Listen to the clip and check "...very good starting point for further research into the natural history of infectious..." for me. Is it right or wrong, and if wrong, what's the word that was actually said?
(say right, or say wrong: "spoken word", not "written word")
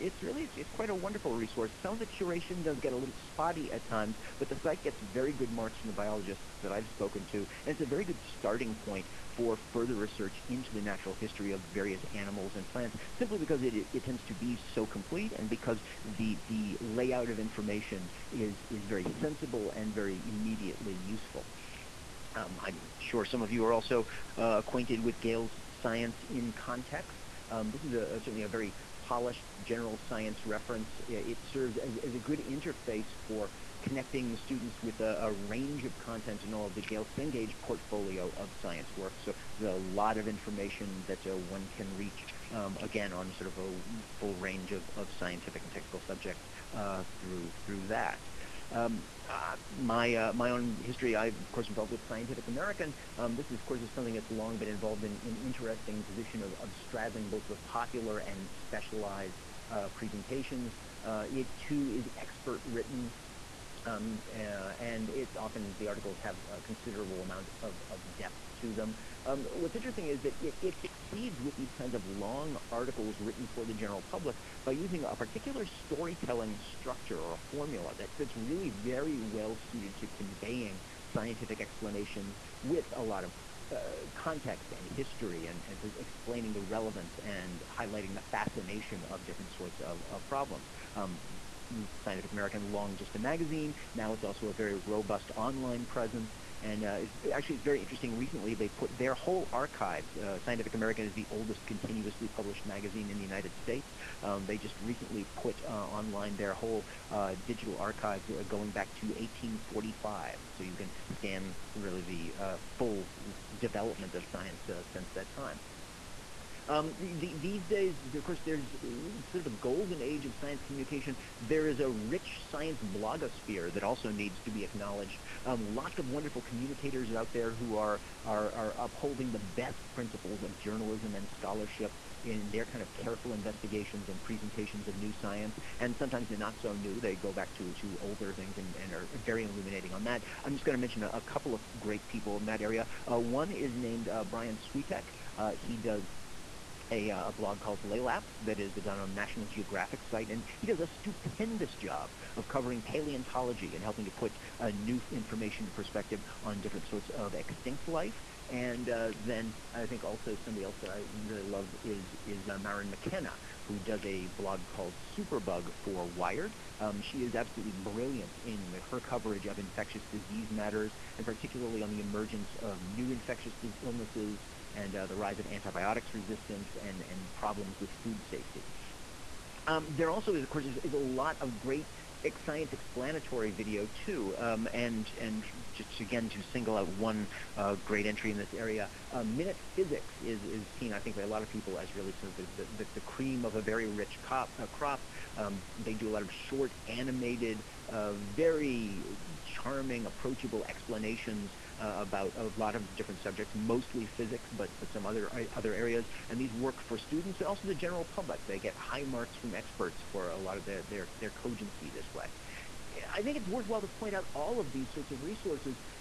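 wrong: "various", not "infectious".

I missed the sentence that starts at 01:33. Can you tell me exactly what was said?
Now it's also a very robust online presence.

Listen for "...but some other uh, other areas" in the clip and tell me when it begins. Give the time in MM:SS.
03:24.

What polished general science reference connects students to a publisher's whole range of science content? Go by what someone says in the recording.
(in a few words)
Science in Context.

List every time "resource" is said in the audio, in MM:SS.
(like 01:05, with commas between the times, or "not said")
00:01, 03:35.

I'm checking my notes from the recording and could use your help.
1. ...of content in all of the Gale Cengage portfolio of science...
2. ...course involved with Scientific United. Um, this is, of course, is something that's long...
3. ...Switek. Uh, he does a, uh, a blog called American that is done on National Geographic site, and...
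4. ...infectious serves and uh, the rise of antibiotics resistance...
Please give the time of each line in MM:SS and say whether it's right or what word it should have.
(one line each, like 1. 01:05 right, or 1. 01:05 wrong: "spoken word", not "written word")
1. 00:35 right
2. 00:51 wrong: "American", not "United"
3. 02:24 wrong: "Laelaps", not "American"
4. 02:53 wrong: "illnesses", not "serves".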